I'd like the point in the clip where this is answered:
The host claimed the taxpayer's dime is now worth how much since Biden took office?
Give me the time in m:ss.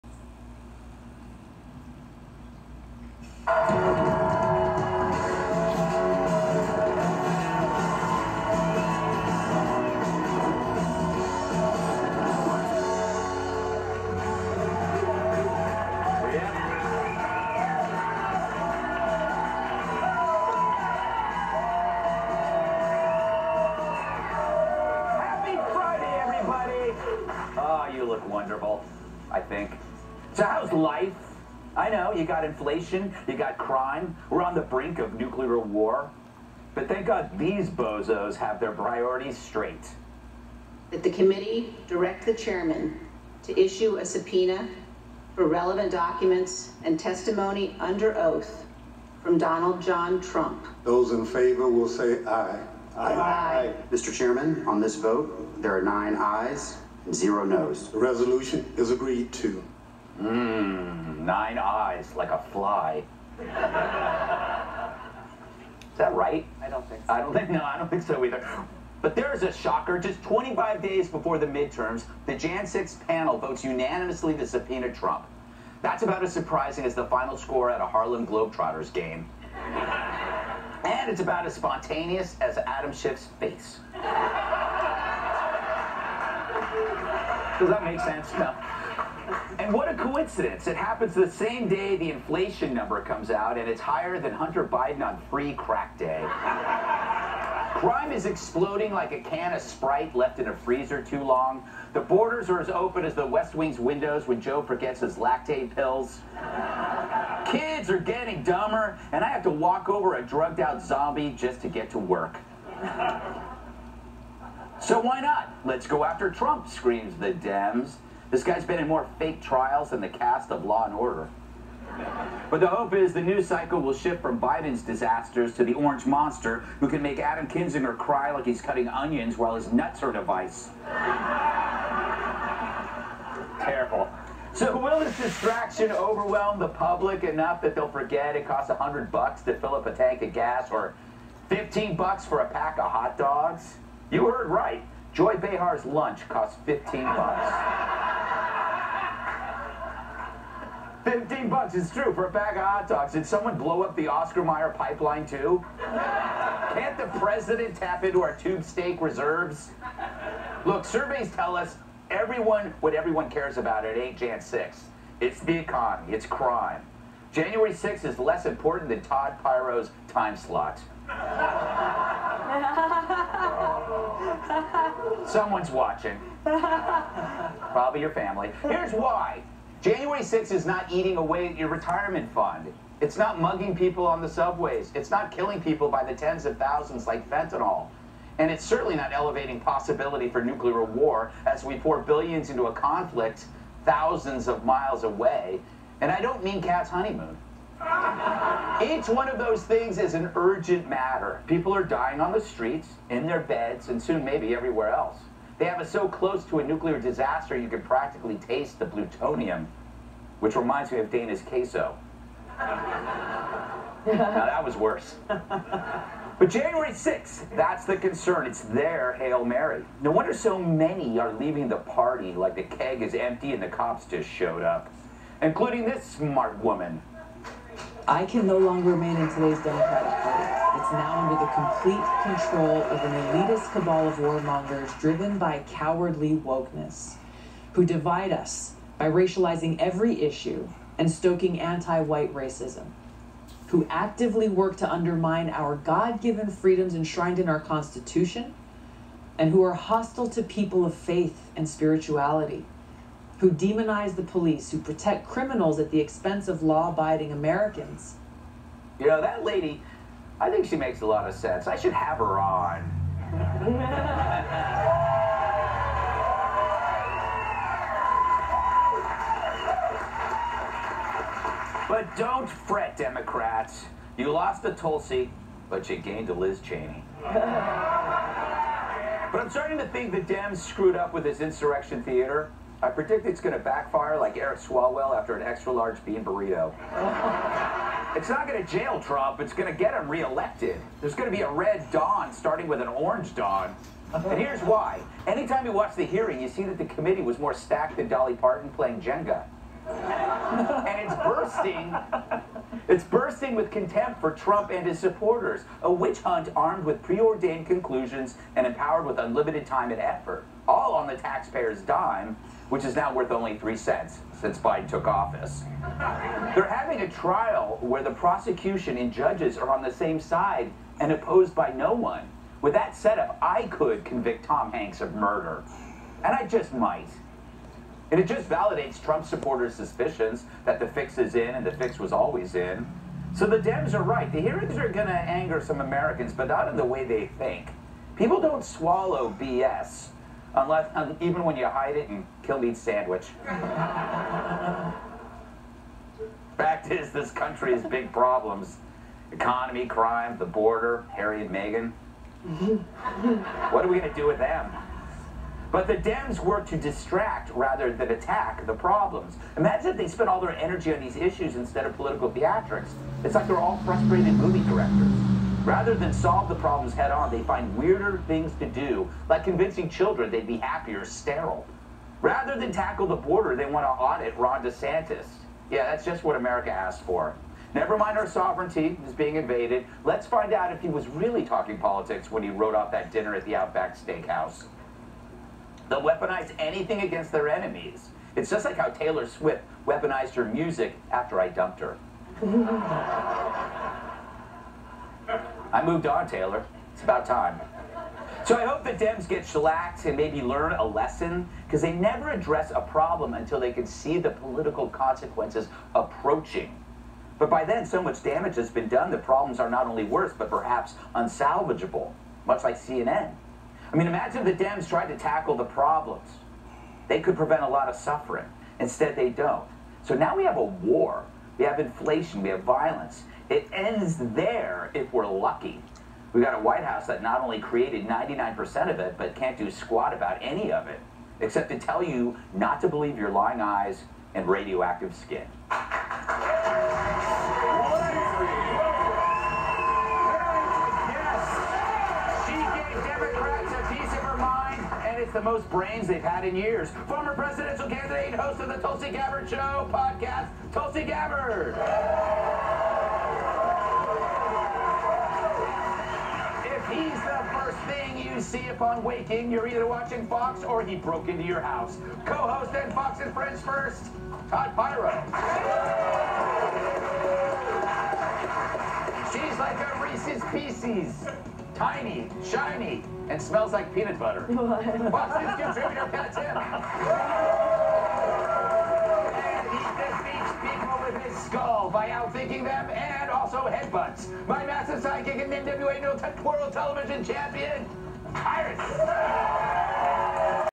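5:13.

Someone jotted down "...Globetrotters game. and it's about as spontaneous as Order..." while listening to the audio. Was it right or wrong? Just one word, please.
wrong.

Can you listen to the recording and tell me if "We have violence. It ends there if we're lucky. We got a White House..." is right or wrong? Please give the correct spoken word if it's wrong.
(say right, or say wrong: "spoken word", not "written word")
right.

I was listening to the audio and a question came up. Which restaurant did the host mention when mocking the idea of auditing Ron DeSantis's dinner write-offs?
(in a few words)
Outback Steakhouse.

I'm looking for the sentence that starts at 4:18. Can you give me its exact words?
You know, that lady I think she makes a lot of sense.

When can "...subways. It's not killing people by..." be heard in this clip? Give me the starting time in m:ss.
3:04.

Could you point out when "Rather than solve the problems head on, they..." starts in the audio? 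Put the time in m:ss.
6:05.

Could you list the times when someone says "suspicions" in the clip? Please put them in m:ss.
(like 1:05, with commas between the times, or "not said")
5:29.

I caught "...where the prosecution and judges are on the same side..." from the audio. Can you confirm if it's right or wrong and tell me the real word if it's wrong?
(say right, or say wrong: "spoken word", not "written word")
right.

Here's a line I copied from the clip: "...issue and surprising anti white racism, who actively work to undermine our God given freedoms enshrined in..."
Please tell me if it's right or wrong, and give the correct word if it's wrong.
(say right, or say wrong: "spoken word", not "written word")
wrong: "stoking", not "surprising".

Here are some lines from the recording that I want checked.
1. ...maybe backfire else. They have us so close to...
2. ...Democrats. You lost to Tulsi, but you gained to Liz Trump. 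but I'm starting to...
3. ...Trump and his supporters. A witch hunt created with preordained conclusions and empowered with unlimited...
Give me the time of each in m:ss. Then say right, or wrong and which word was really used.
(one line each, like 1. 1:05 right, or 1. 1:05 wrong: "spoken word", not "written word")
1. 3:24 wrong: "everywhere", not "backfire"
2. 4:32 wrong: "Cheney", not "Trump"
3. 5:04 wrong: "armed", not "created".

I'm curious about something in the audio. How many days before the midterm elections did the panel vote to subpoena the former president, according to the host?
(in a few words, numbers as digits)
25.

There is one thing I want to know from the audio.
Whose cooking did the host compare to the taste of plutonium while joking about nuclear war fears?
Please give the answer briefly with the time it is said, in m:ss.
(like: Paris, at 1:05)
Dana, at 3:31.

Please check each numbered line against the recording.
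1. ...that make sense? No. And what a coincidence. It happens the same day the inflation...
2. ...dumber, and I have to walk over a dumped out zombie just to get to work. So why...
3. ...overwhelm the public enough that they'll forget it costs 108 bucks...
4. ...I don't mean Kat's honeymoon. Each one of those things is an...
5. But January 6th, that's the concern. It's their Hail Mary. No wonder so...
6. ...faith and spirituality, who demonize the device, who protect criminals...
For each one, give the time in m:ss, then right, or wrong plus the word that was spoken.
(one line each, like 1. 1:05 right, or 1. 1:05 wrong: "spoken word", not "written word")
1. 1:27 right
2. 1:48 wrong: "drugged", not "dumped"
3. 2:15 wrong: "100", not "108"
4. 3:16 right
5. 3:35 right
6. 4:10 wrong: "police", not "device".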